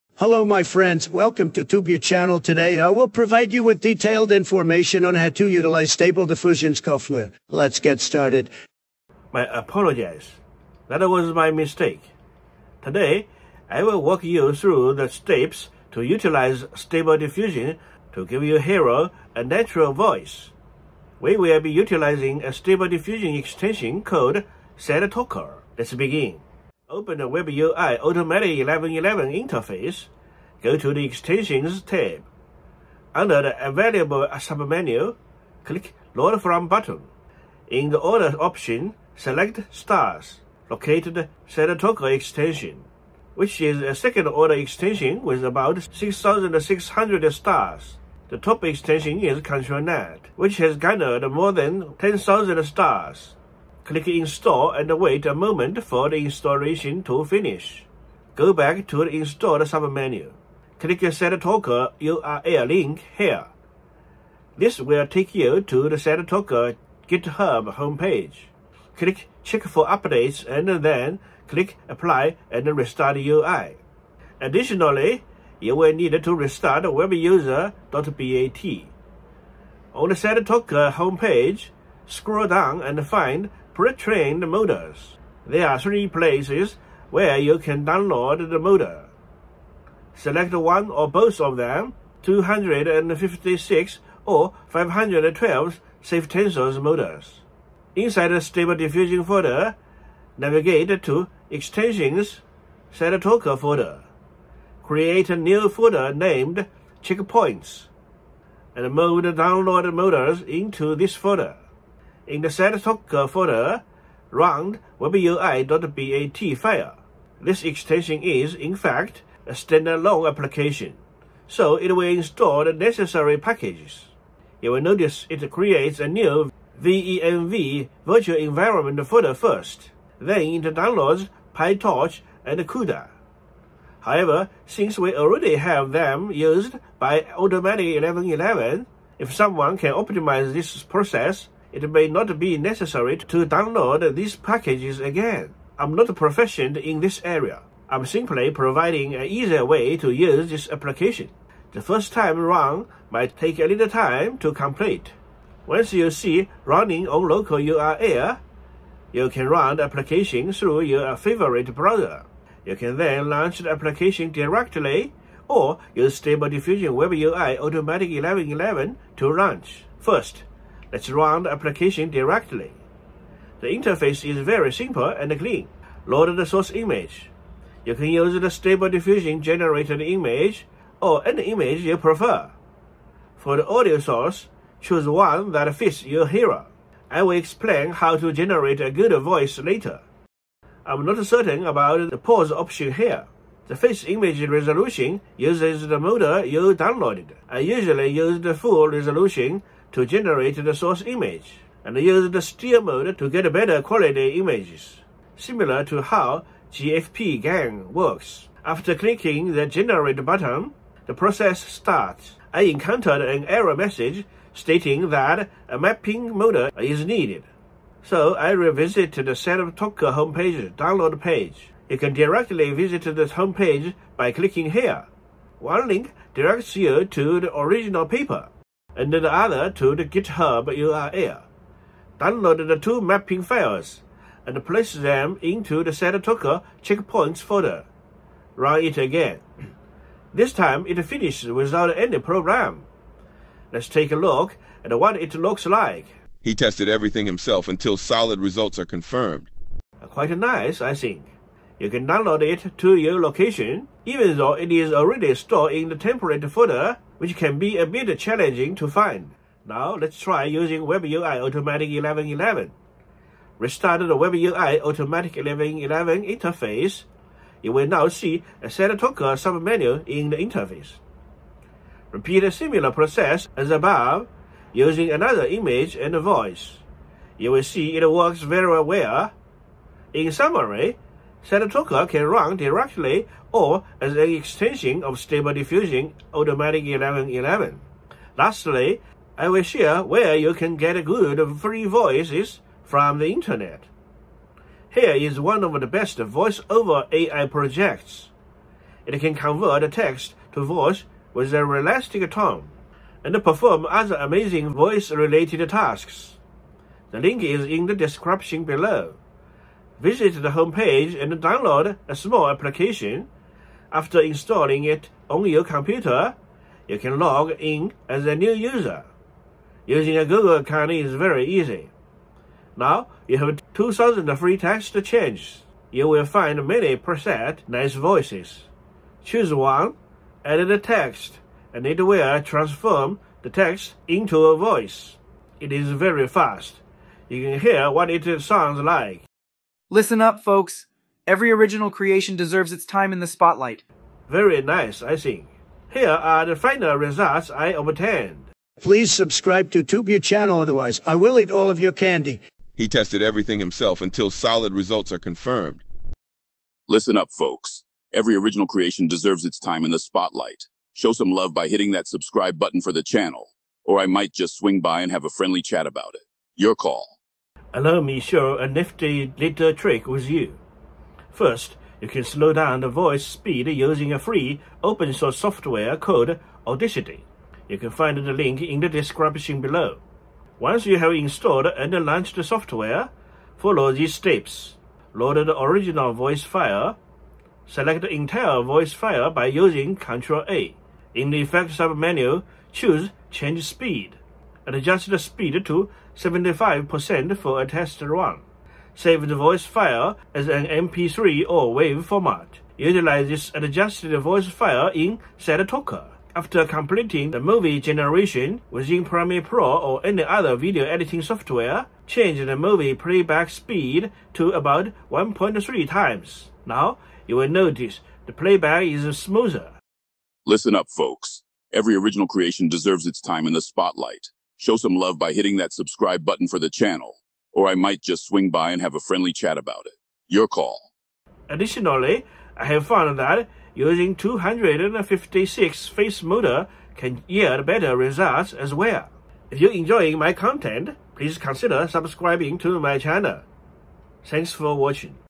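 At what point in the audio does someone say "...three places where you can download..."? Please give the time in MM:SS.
01:25.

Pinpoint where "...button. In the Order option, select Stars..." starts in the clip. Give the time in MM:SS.
00:36.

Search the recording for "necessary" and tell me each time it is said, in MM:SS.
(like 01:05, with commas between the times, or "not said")
02:02, 02:22.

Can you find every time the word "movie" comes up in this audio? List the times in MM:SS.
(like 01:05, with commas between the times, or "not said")
06:47, 06:52.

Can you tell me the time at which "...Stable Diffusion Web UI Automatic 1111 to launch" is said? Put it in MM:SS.
02:46.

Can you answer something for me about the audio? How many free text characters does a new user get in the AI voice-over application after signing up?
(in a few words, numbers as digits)
2,000.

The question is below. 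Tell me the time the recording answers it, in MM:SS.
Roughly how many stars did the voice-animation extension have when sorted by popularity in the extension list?
00:45.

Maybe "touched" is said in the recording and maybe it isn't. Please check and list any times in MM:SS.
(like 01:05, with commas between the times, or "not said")
not said.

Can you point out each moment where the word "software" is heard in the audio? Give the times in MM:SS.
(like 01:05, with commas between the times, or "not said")
00:06, 06:15, 06:22, 06:51.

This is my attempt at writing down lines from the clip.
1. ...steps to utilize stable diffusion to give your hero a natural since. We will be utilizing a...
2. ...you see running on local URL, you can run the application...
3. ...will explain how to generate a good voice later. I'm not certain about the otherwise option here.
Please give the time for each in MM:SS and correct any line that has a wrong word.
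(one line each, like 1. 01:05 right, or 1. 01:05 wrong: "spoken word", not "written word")
1. 00:15 wrong: "voice", not "since"
2. 02:35 right
3. 03:07 wrong: "pause", not "otherwise".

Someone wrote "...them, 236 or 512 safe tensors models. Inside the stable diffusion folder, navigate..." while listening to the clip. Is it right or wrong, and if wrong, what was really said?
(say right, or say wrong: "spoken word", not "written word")
wrong: "256", not "236".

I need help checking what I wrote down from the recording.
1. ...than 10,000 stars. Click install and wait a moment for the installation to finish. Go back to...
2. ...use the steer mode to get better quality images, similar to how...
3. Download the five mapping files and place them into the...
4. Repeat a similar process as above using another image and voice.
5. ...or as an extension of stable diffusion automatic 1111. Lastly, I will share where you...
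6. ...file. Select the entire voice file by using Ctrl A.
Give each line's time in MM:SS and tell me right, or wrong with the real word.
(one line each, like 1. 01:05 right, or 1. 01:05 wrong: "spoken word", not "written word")
1. 00:51 right
2. 03:21 right
3. 03:52 wrong: "two", not "five"
4. 04:32 right
5. 04:43 right
6. 06:26 right.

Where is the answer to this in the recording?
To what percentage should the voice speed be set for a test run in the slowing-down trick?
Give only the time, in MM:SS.
06:36.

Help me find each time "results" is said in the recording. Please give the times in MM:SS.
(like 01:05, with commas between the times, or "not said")
04:08, 05:46, 05:54, 07:17.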